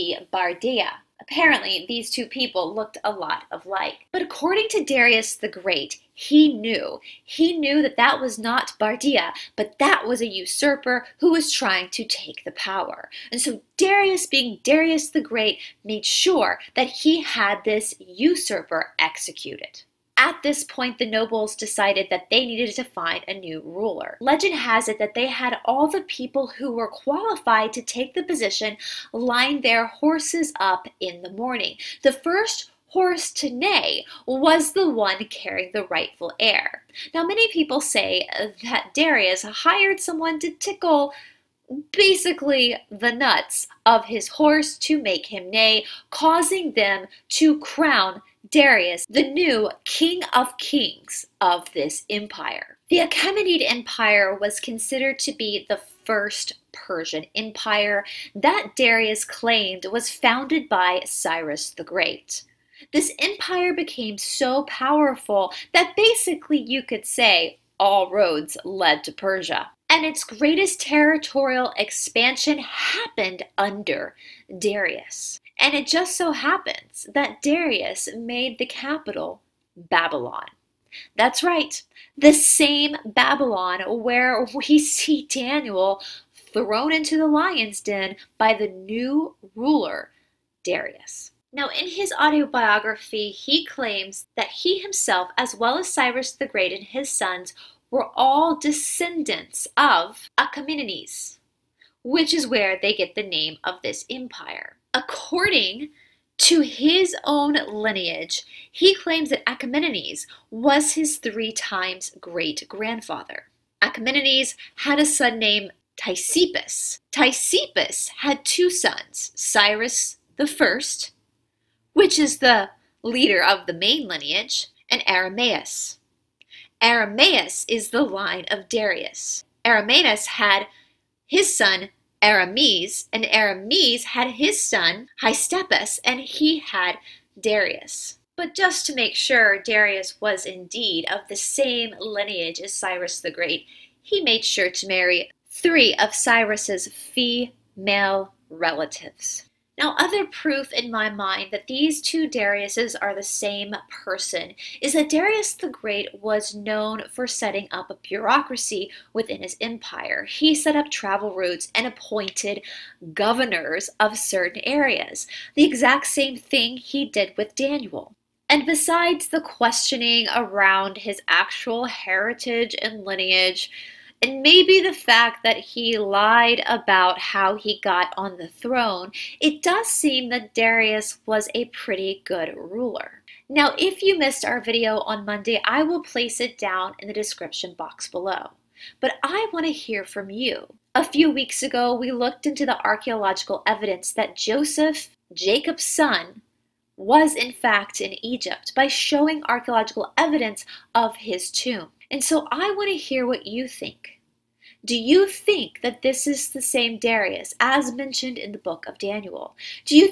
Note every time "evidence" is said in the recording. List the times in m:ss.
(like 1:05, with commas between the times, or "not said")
3:13, 3:20.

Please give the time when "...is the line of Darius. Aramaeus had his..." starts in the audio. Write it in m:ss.
2:07.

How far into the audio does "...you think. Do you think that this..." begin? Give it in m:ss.
3:23.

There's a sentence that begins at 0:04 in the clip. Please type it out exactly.
But according to Darius the Great, he knew.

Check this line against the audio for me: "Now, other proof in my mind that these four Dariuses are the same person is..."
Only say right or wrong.
wrong.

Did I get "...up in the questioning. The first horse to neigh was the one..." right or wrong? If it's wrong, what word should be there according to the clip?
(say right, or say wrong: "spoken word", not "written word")
wrong: "morning", not "questioning".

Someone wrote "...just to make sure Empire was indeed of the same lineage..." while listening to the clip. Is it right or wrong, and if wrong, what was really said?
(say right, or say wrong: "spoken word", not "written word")
wrong: "Darius", not "Empire".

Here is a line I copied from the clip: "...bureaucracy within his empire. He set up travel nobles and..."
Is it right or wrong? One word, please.
wrong.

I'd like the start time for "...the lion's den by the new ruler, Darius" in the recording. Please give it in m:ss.
1:27.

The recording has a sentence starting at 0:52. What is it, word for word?
The Achaemenid Empire was considered to be the first Persian empire that Darius claimed was founded by Cyrus the Great.